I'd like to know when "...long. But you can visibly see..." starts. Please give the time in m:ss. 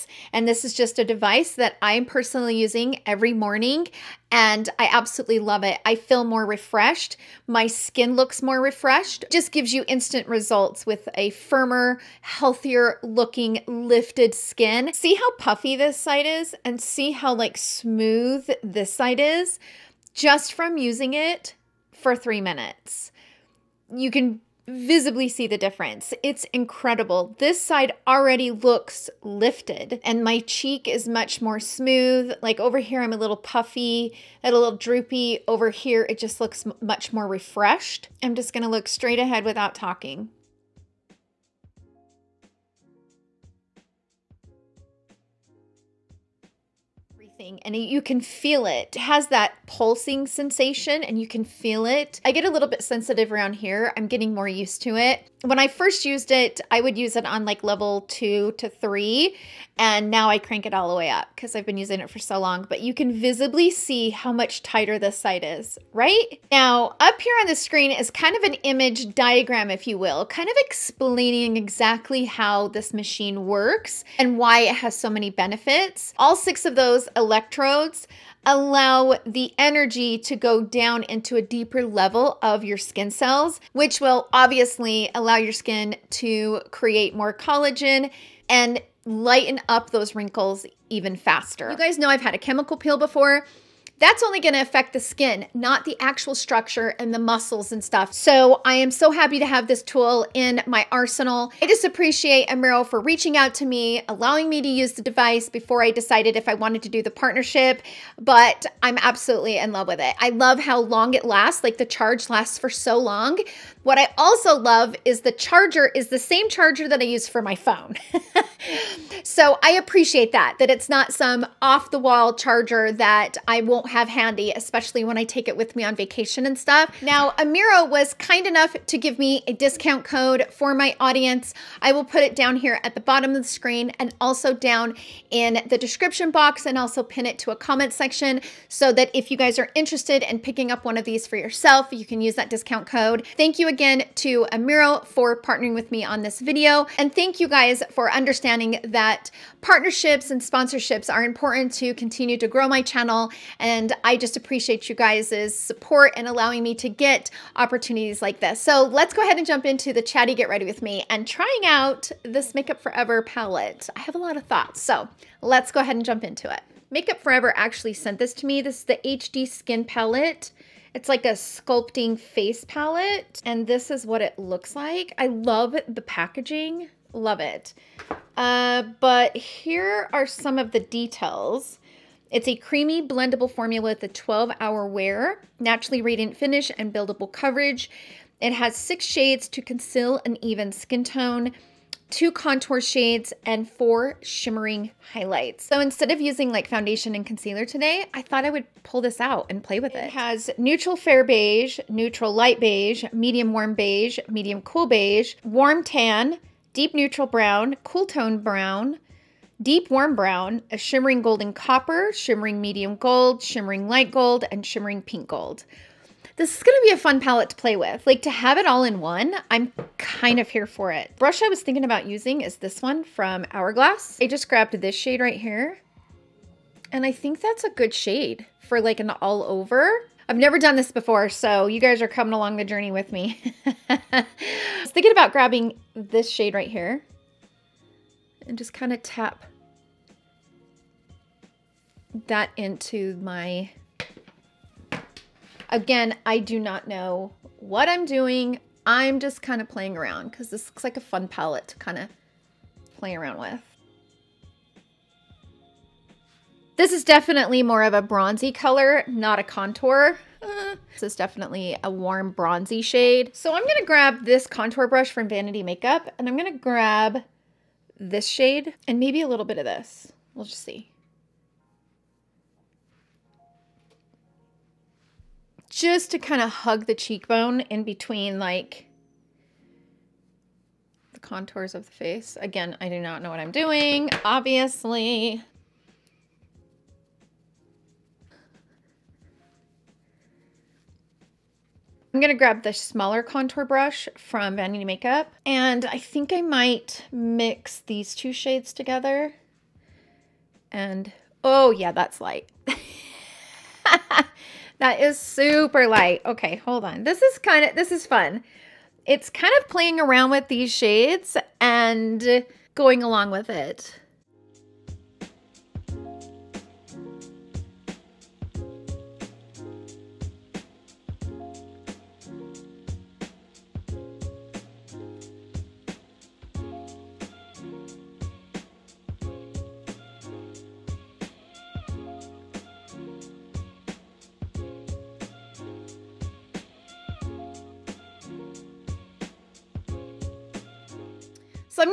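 1:02.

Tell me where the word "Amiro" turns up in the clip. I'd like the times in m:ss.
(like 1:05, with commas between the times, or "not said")
1:42, 2:07, 2:24.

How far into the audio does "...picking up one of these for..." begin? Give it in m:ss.
2:20.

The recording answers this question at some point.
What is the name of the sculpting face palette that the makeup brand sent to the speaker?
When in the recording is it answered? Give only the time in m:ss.
2:49.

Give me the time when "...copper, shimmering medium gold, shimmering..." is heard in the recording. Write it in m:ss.
3:31.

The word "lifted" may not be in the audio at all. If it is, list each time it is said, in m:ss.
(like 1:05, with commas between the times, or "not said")
0:13, 0:29.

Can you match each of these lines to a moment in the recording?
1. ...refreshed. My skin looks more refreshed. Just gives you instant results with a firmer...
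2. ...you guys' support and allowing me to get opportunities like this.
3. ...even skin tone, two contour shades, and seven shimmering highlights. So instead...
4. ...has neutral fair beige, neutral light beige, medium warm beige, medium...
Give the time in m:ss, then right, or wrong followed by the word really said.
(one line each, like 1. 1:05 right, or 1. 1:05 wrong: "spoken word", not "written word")
1. 0:06 right
2. 2:34 right
3. 3:10 wrong: "four", not "seven"
4. 3:20 right.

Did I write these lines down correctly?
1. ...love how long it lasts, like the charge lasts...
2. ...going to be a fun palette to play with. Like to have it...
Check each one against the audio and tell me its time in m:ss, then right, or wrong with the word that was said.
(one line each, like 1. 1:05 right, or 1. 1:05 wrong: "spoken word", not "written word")
1. 1:50 right
2. 3:36 right.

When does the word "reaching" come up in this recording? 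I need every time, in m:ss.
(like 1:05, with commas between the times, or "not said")
1:42.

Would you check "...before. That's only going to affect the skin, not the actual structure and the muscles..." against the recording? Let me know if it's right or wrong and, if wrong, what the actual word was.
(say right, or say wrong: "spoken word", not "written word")
right.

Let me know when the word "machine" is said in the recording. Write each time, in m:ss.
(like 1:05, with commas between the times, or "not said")
1:12.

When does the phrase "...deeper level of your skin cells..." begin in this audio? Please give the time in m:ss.
1:21.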